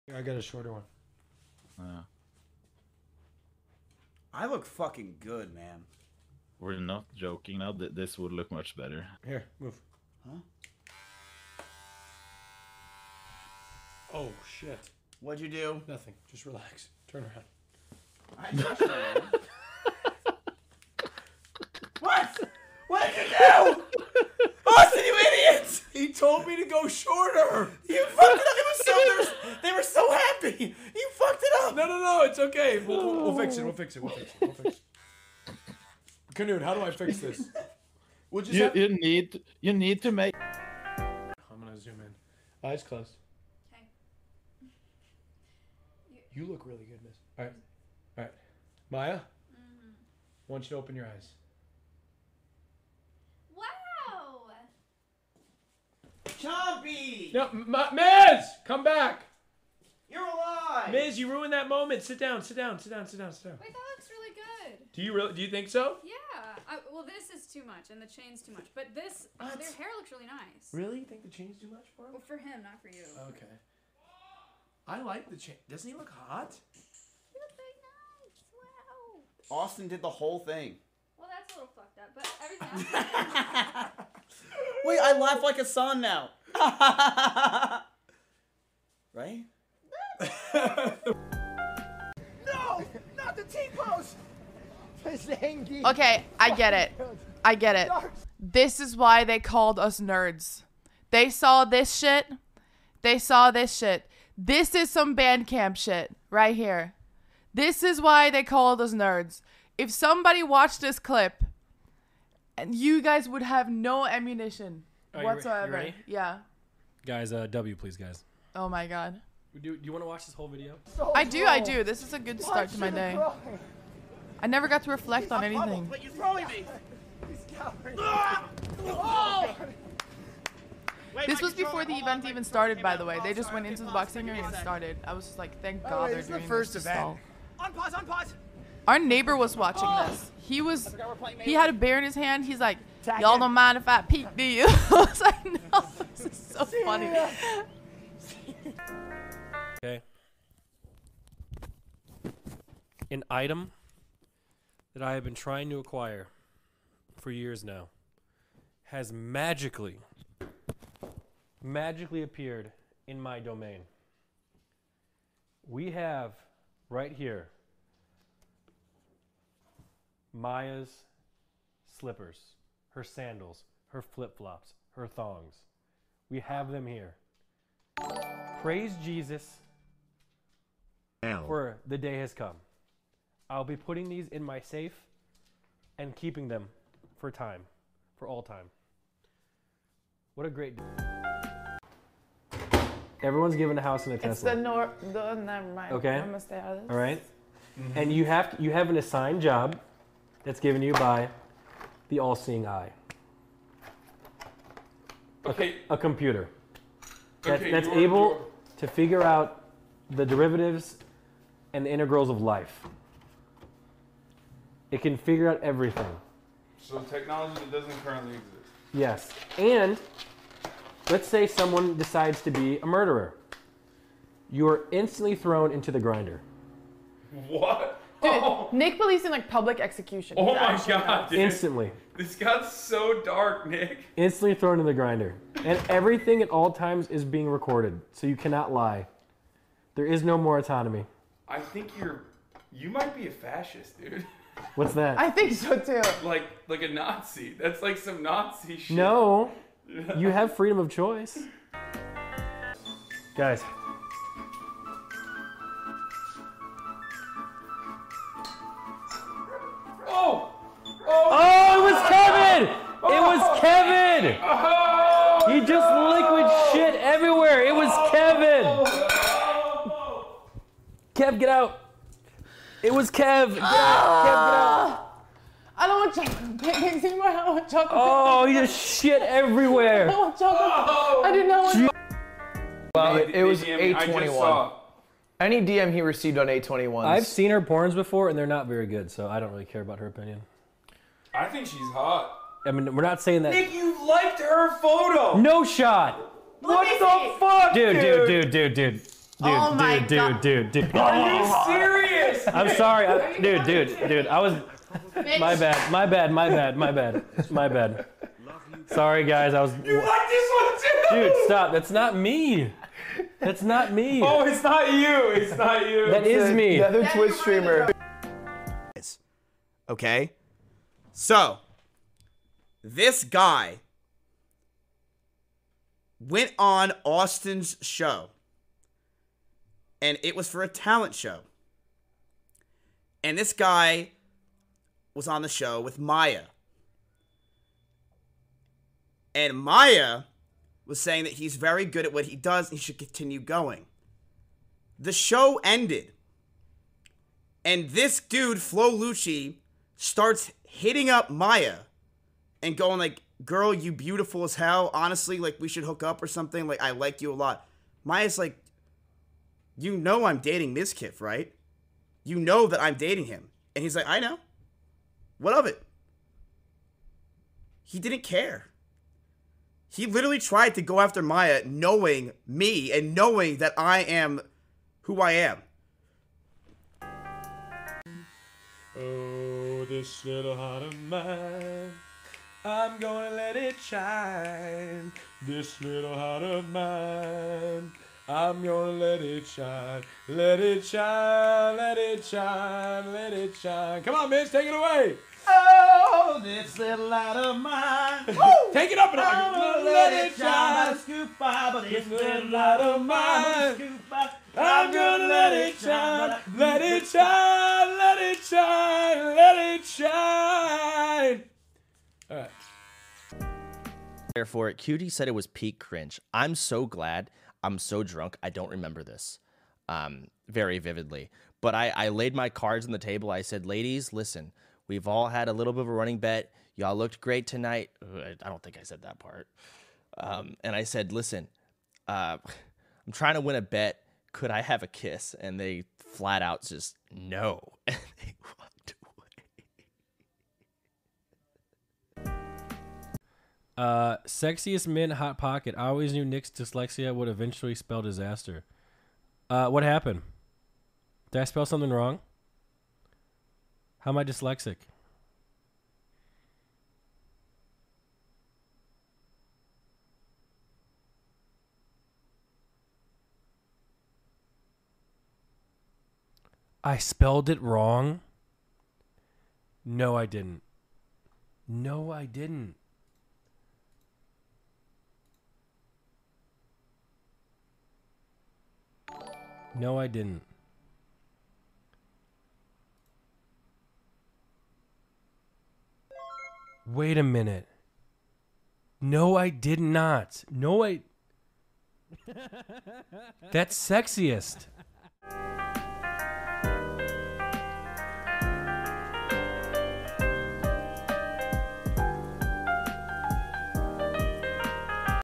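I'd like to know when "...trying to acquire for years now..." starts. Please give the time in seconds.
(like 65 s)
155 s.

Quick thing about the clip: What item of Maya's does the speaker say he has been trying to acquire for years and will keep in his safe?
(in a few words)
Slippers.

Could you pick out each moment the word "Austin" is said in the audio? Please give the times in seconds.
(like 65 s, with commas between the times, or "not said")
24 s, 79 s, 327 s.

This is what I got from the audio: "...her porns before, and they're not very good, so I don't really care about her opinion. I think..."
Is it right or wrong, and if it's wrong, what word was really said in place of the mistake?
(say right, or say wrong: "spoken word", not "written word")
right.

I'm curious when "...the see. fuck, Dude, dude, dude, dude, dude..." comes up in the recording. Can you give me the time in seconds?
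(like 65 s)
296 s.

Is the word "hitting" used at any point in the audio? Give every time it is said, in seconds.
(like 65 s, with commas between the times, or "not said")
350 s.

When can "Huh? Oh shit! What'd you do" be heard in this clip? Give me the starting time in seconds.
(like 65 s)
10 s.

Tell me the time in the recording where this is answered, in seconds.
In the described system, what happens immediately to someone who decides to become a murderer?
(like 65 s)
225 s.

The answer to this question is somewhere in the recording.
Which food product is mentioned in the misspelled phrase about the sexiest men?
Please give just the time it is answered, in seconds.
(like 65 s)
445 s.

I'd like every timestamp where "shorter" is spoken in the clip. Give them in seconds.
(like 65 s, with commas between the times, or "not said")
0 s, 26 s.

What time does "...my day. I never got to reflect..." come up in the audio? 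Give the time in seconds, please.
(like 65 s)
122 s.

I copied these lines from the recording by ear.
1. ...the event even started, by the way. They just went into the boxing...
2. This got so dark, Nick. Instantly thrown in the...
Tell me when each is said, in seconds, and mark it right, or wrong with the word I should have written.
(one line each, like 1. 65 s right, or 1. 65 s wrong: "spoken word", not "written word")
1. 131 s right
2. 232 s right.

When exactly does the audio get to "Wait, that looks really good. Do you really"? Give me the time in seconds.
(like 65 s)
63 s.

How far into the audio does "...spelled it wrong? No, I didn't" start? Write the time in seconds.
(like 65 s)
466 s.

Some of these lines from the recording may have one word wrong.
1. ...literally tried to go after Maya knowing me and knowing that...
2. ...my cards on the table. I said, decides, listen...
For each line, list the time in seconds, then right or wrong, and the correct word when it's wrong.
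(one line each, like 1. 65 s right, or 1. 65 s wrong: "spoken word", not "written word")
1. 370 s right
2. 422 s wrong: "ladies", not "decides".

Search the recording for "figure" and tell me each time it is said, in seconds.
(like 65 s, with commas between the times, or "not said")
208 s, 215 s.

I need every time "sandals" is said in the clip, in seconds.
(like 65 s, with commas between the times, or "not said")
173 s.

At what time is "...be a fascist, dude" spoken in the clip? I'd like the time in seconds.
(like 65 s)
243 s.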